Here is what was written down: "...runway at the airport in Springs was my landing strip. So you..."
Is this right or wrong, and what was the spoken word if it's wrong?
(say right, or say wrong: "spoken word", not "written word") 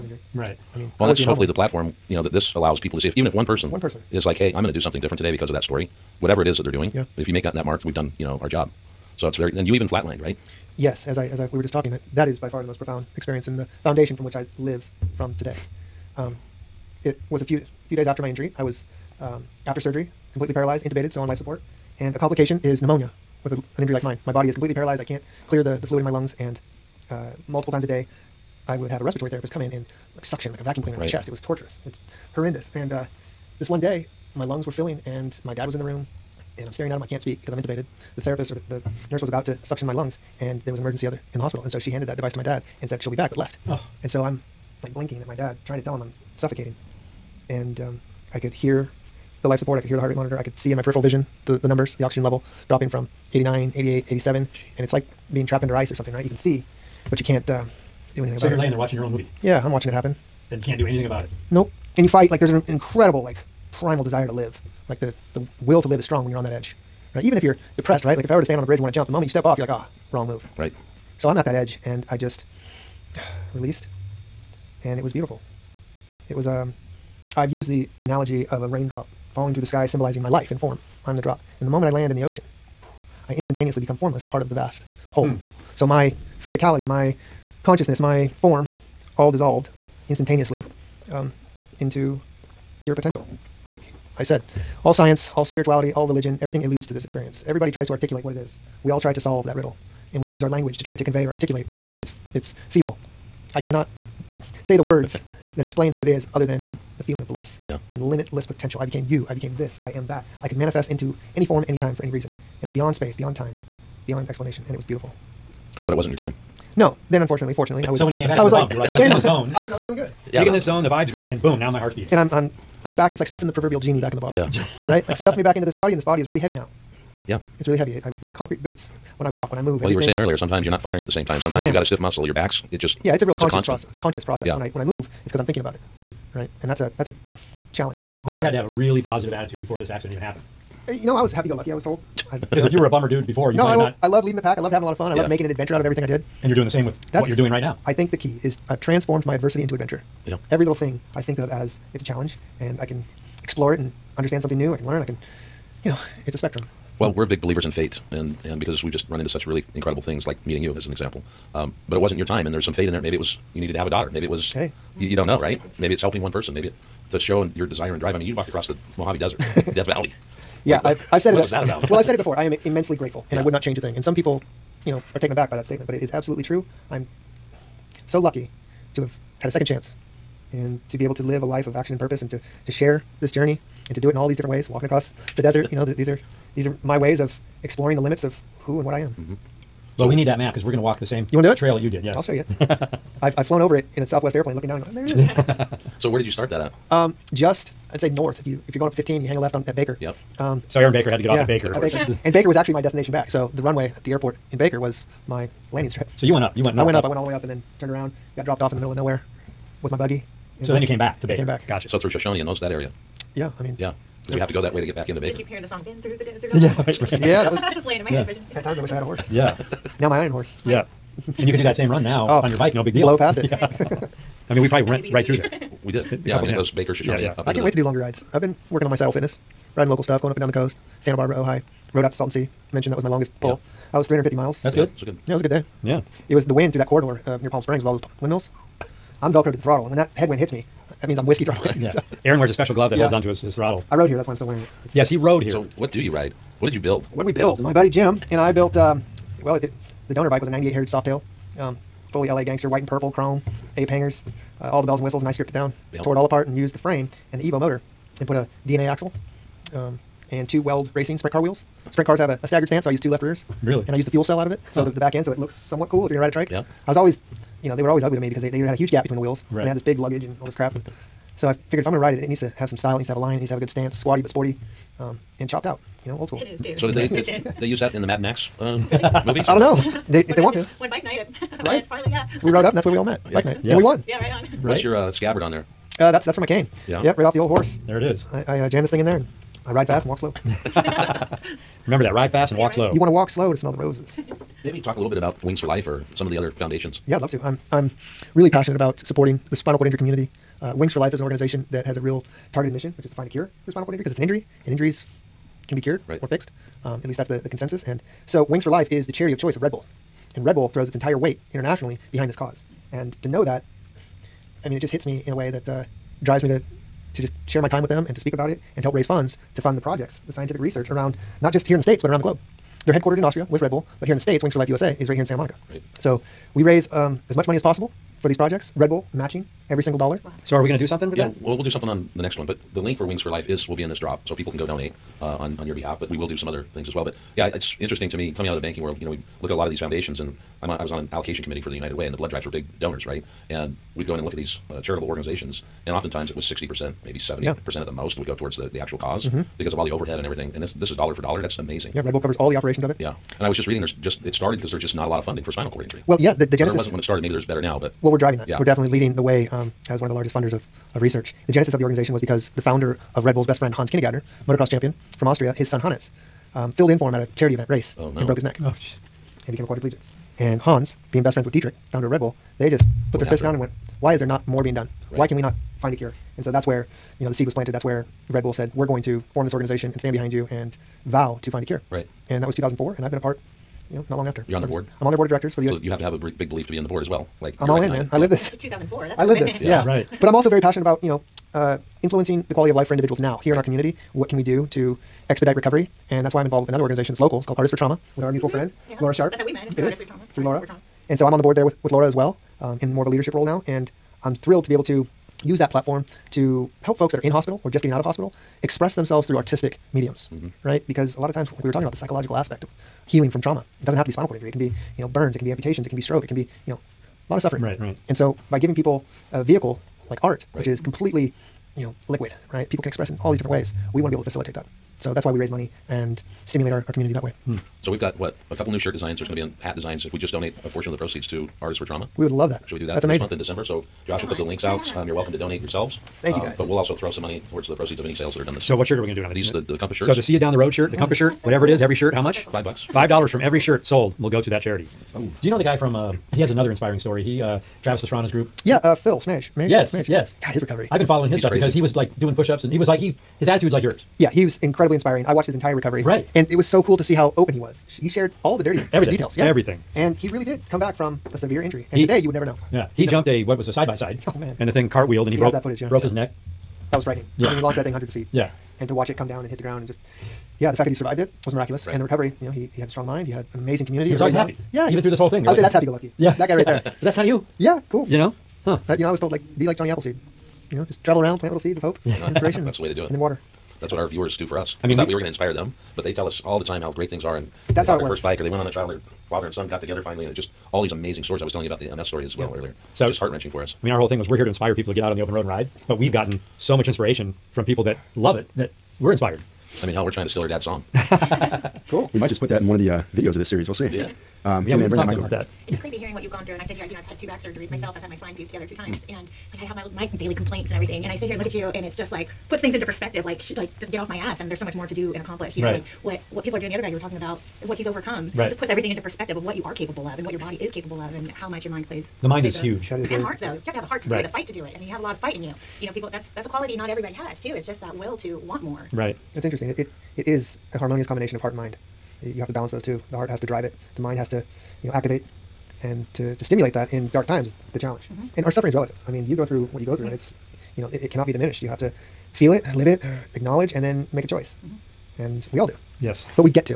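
wrong: "Baker", not "Springs".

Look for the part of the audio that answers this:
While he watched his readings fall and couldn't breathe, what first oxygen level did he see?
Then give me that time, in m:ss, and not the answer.
0:53.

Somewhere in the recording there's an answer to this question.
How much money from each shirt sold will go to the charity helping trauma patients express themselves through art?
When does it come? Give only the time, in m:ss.
7:22.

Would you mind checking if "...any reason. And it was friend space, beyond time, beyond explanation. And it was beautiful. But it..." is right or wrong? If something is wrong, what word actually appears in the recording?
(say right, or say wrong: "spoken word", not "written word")
wrong: "beyond", not "friend".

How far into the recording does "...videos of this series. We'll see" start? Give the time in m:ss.
8:23.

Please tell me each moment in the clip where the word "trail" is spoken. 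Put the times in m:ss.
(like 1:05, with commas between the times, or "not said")
3:11.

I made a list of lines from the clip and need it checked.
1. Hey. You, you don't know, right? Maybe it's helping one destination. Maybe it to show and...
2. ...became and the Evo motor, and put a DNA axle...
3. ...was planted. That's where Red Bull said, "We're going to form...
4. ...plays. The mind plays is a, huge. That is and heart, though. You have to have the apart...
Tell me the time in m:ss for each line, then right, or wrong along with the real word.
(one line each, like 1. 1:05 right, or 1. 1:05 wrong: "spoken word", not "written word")
1. 2:44 wrong: "person", not "destination"
2. 4:16 wrong: "frame", not "became"
3. 6:17 right
4. 8:41 wrong: "heart", not "apart".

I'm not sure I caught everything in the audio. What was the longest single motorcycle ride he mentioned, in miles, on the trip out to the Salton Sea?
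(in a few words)
350.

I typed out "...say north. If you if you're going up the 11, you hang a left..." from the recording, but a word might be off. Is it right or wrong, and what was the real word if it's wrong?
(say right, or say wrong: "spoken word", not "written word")
wrong: "15", not "11".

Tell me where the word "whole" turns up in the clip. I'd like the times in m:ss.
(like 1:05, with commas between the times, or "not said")
1:25, 7:55, 8:14.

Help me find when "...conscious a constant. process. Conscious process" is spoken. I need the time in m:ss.
2:13.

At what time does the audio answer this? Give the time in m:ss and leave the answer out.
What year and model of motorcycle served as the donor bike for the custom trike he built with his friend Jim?
4:10.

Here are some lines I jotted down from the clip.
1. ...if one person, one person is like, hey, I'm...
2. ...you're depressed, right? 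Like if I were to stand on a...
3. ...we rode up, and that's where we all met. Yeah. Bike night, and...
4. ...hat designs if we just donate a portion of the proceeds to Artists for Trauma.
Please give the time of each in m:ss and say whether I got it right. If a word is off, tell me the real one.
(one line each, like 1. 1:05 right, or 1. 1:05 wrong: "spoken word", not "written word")
1. 0:03 right
2. 1:07 right
3. 4:42 right
4. 7:09 right.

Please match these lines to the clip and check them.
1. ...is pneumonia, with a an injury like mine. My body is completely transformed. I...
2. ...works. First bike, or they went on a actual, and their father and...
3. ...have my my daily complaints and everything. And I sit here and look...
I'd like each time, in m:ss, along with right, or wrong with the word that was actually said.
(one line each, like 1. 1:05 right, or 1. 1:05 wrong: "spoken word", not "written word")
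1. 0:22 wrong: "paralyzed", not "transformed"
2. 8:08 wrong: "trial", not "actual"
3. 8:29 right.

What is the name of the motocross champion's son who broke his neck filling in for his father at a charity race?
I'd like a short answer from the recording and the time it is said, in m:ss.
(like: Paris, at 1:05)
Hannes, at 6:05.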